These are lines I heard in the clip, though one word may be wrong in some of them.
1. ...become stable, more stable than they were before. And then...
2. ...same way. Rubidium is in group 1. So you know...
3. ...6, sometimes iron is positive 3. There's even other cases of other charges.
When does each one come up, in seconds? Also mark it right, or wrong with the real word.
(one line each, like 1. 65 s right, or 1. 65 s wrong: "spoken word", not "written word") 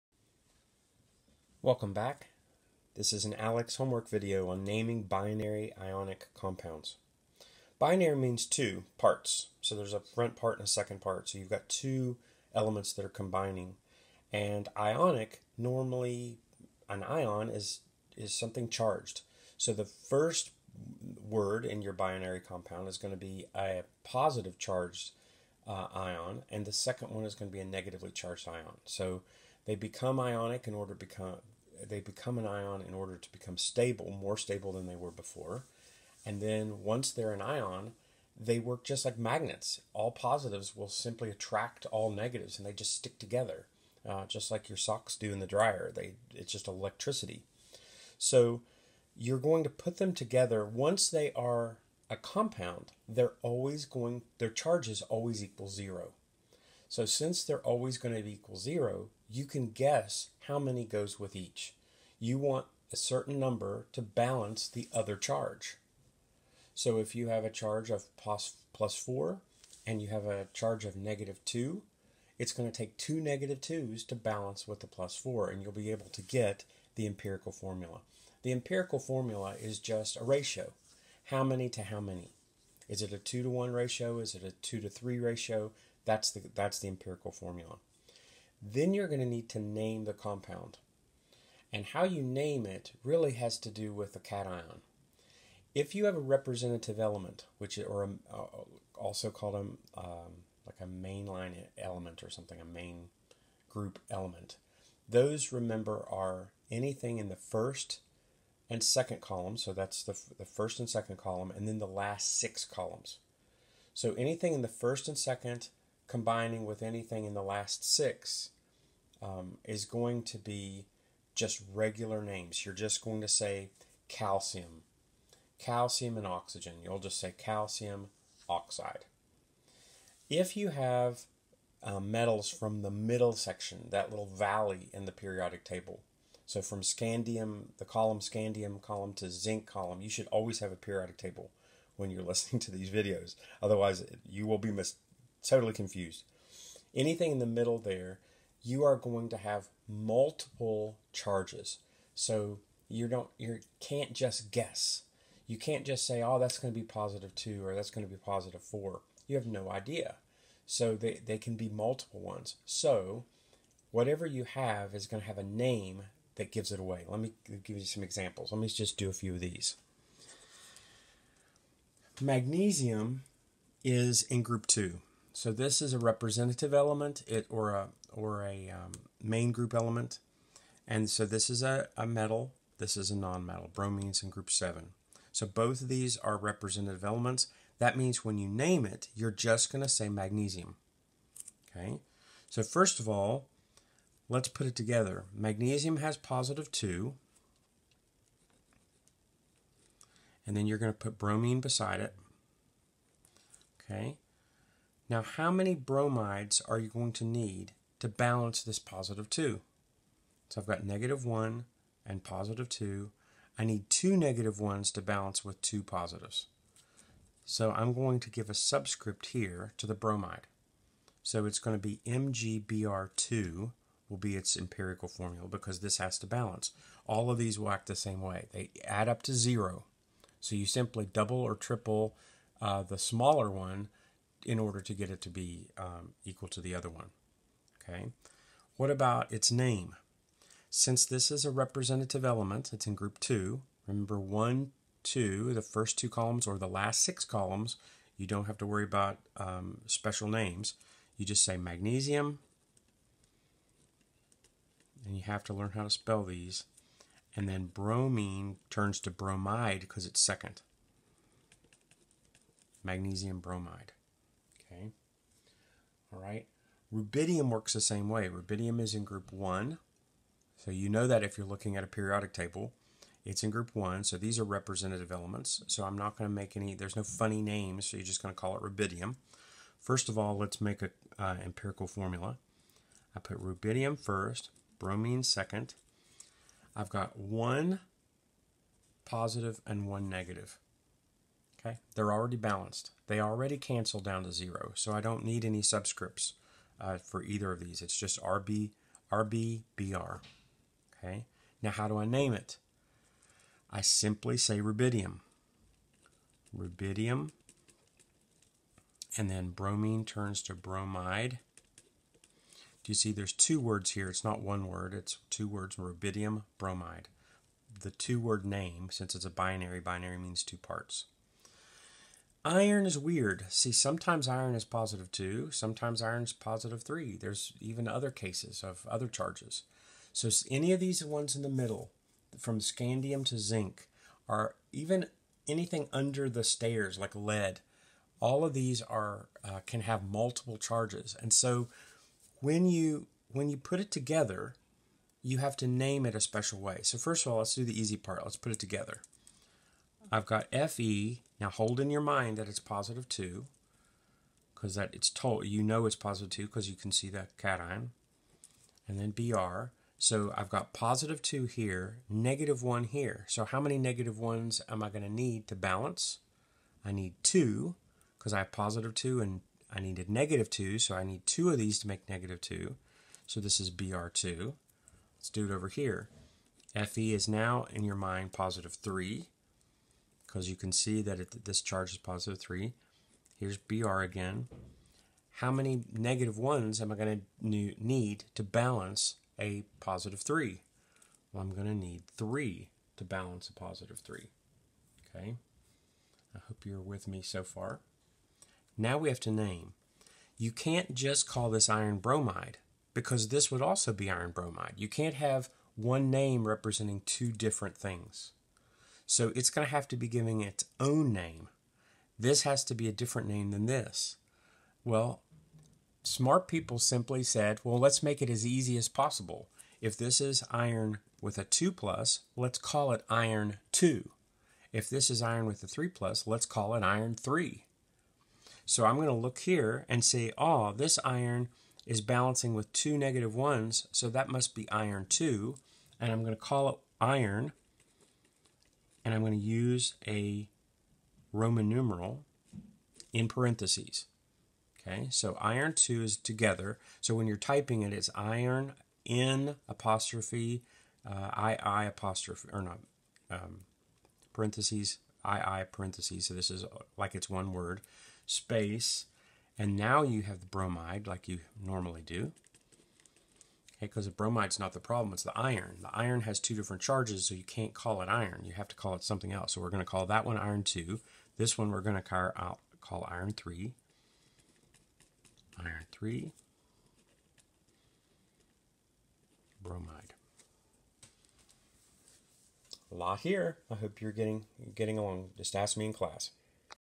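1. 33 s right
2. 267 s right
3. 325 s wrong: "2", not "6".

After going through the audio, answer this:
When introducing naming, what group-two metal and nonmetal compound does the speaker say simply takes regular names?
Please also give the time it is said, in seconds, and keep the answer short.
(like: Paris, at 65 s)
Calcium oxide, at 127 s.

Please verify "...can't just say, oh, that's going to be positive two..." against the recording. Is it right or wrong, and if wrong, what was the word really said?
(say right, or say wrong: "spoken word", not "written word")
right.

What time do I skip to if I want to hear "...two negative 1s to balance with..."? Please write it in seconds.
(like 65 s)
213 s.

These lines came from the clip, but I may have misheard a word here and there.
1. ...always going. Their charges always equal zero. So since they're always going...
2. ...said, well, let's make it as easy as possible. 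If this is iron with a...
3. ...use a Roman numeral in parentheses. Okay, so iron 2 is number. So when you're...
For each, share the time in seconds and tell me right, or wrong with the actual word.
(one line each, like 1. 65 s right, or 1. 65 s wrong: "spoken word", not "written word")
1. 53 s right
2. 417 s right
3. 439 s wrong: "together", not "number".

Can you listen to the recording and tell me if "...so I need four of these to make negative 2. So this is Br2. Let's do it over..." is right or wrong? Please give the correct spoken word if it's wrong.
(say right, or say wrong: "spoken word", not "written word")
wrong: "two", not "four".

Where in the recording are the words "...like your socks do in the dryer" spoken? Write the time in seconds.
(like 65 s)
44 s.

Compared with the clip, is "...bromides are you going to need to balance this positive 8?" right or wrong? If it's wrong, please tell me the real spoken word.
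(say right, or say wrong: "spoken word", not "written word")
wrong: "2", not "8".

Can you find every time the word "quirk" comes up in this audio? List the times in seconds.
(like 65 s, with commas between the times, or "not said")
not said.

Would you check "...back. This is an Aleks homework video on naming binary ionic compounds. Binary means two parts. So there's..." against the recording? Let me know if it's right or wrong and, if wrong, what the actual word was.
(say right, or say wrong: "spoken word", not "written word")
right.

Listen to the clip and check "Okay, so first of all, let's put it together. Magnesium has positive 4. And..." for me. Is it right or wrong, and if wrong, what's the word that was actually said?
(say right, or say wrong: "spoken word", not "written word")
wrong: "2", not "4".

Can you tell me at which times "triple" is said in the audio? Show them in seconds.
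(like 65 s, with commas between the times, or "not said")
231 s.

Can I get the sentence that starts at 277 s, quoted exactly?
So you're just going to call it rubidium.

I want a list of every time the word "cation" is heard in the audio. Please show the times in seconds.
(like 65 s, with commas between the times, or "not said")
94 s, 357 s.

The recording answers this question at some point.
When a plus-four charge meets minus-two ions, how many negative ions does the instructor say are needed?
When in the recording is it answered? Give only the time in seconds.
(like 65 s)
72 s.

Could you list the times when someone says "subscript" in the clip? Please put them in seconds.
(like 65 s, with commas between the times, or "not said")
218 s, 295 s.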